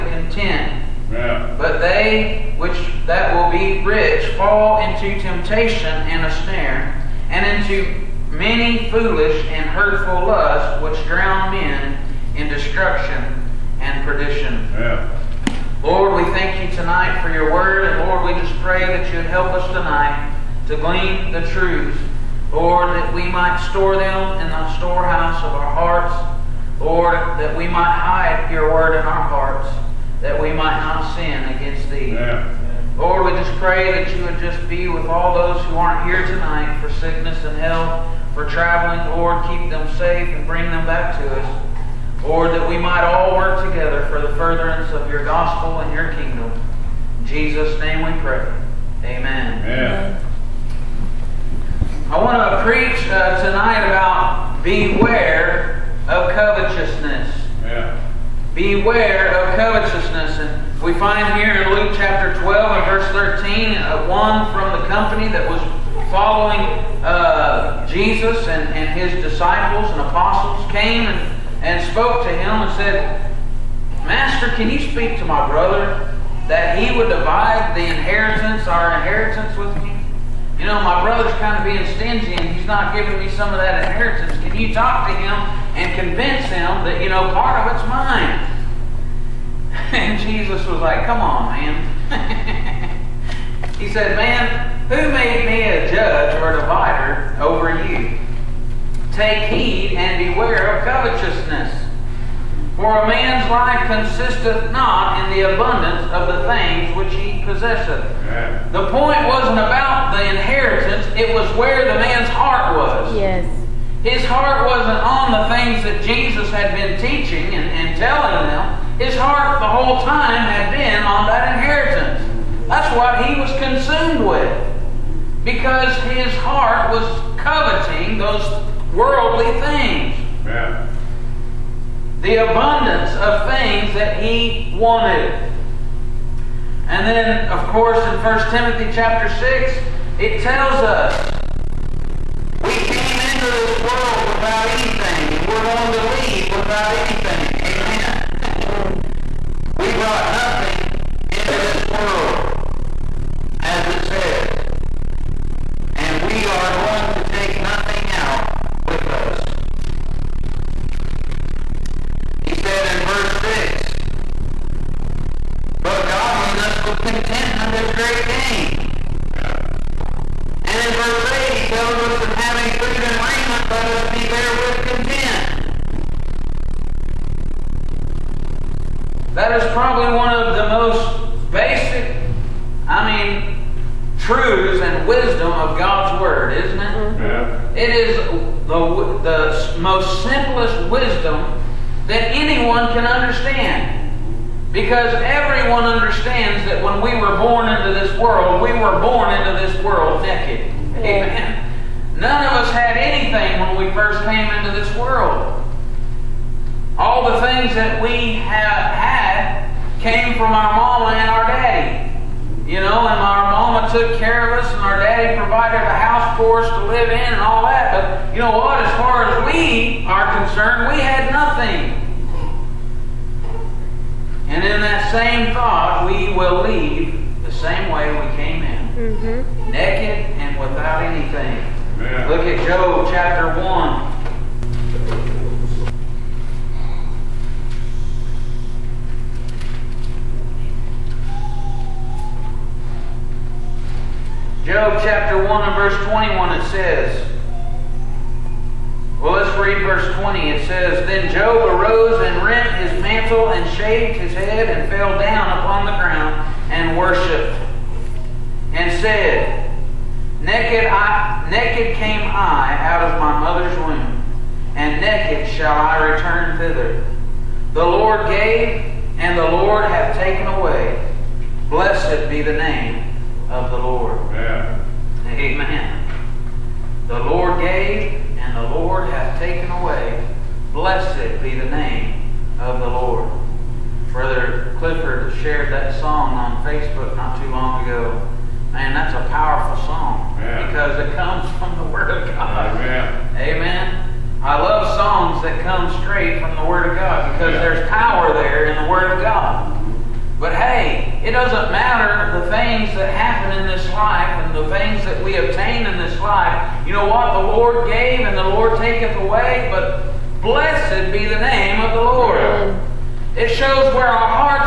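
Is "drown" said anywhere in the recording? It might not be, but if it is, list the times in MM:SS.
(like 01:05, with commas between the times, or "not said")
00:11.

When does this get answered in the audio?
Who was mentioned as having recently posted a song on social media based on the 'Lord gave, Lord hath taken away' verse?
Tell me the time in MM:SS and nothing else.
04:44.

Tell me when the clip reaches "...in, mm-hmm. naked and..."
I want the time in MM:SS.
03:48.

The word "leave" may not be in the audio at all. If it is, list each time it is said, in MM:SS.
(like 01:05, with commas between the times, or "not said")
02:26, 03:46.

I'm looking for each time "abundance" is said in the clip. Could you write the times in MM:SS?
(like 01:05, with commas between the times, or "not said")
01:45, 02:12.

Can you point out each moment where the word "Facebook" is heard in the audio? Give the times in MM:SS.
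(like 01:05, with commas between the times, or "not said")
04:46.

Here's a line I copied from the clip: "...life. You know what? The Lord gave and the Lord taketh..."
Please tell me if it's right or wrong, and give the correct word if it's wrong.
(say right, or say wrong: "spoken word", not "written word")
right.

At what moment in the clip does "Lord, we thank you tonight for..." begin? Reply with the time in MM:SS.
00:15.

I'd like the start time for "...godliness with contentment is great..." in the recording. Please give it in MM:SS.
02:46.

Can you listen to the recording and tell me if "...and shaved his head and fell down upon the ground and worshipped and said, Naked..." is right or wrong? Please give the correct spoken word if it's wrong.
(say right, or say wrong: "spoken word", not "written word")
right.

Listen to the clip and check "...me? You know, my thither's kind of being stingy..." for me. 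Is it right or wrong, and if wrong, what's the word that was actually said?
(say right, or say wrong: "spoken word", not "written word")
wrong: "brother", not "thither".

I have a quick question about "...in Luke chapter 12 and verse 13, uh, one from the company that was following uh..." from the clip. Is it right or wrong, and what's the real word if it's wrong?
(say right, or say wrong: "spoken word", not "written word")
right.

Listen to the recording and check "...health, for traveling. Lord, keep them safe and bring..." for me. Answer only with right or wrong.
right.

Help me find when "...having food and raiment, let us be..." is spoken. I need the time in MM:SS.
02:52.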